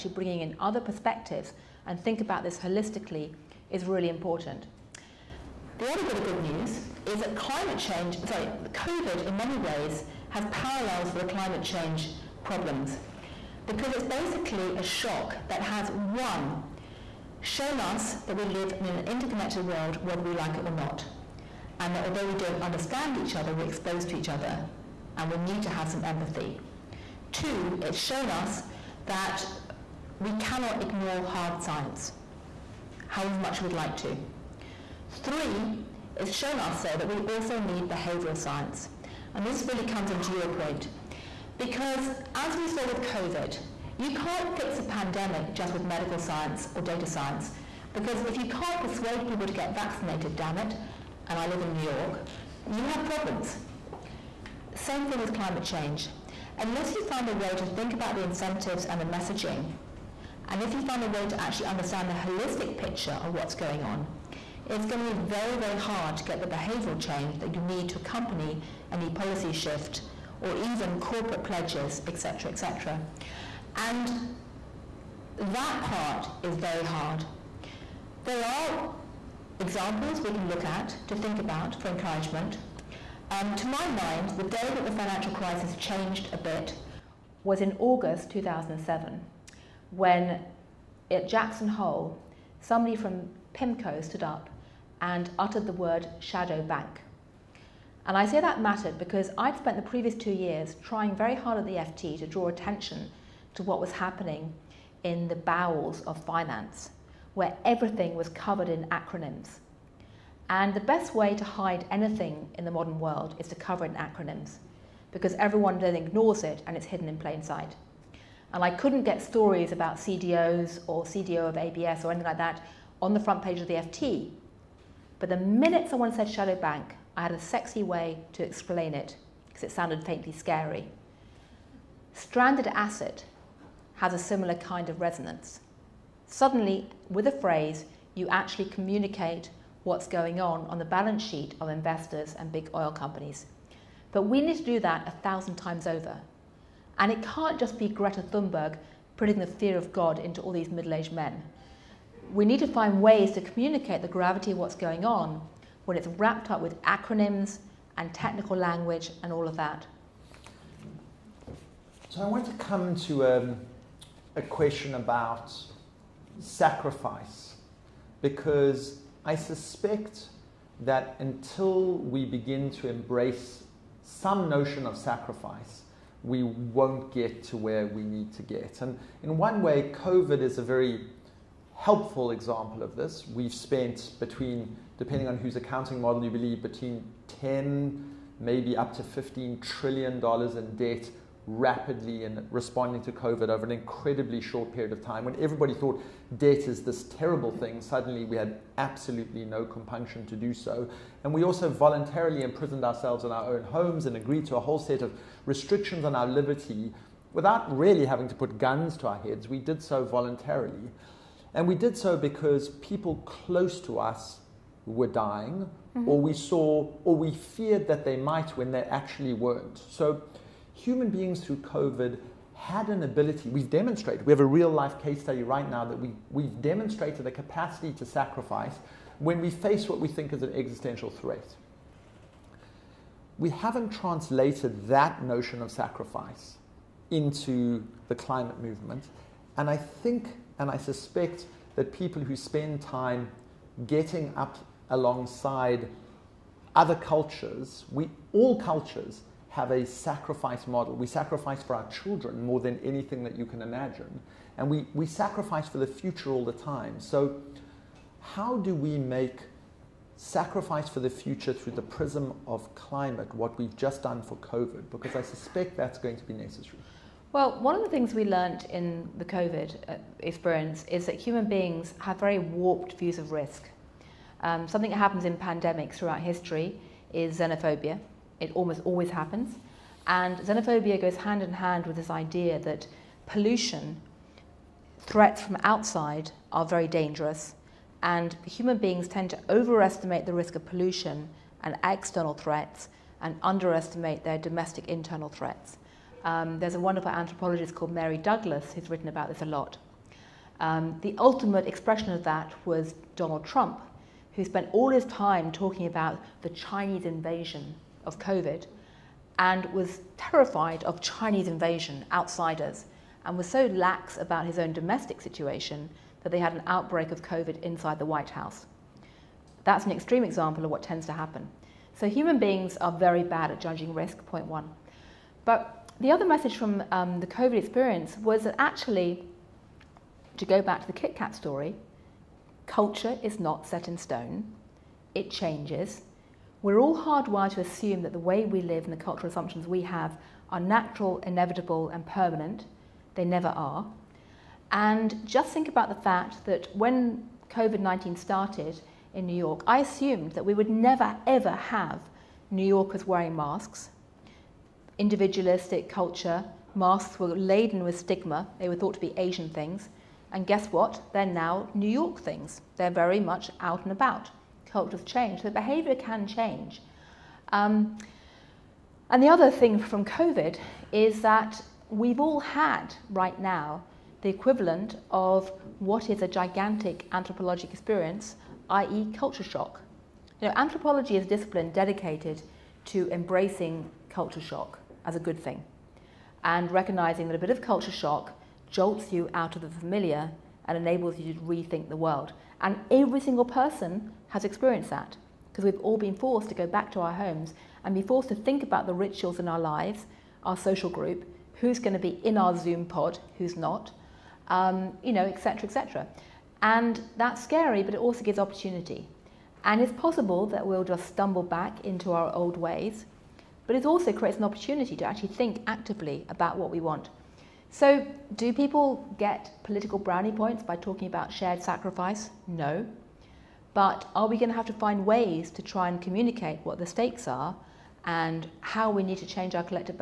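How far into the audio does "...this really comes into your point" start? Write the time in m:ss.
0:39.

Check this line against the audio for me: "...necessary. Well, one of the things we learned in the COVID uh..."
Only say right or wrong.
right.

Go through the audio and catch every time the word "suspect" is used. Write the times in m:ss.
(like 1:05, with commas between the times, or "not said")
2:49, 4:00, 4:25.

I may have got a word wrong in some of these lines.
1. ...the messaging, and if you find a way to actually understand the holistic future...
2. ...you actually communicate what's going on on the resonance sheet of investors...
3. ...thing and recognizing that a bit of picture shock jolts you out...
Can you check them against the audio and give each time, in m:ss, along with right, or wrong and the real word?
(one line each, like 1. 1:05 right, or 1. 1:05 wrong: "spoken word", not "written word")
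1. 0:58 wrong: "picture", not "future"
2. 2:18 wrong: "balance", not "resonance"
3. 6:25 wrong: "culture", not "picture".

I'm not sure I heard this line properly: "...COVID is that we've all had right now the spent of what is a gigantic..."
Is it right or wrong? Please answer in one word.
wrong.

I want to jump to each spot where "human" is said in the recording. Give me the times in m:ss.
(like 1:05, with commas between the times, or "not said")
3:40, 4:31, 4:48, 5:22.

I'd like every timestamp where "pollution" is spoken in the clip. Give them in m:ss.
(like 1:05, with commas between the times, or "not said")
4:43, 4:50.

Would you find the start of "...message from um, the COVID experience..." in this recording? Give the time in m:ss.
5:26.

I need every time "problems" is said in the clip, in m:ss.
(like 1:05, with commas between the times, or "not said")
0:12, 0:53.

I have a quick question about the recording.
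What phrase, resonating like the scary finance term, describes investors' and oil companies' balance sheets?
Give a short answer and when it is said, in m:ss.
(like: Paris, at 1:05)
Stranded asset, at 2:12.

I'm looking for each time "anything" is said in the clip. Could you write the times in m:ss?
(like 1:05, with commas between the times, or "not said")
1:51, 2:02, 4:12.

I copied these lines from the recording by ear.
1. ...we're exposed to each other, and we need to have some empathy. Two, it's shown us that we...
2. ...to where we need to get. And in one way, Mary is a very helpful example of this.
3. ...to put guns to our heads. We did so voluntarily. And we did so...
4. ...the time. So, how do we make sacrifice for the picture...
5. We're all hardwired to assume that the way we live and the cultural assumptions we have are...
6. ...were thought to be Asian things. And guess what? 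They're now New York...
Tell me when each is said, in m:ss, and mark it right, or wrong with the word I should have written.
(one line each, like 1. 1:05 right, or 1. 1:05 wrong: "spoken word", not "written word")
1. 0:23 right
2. 2:57 wrong: "COVID", not "Mary"
3. 3:28 right
4. 4:16 wrong: "future", not "picture"
5. 5:36 right
6. 5:58 right.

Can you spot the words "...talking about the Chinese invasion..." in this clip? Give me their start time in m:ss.
5:05.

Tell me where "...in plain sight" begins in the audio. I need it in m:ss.
1:57.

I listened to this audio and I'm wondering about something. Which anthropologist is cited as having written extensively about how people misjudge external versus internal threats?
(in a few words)
Mary Douglas.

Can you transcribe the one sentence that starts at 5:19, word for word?
That's an extreme example of what tends to happen.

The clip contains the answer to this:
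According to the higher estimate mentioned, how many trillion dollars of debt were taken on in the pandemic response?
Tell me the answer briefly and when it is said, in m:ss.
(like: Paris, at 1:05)
15 trillion dollars, at 3:09.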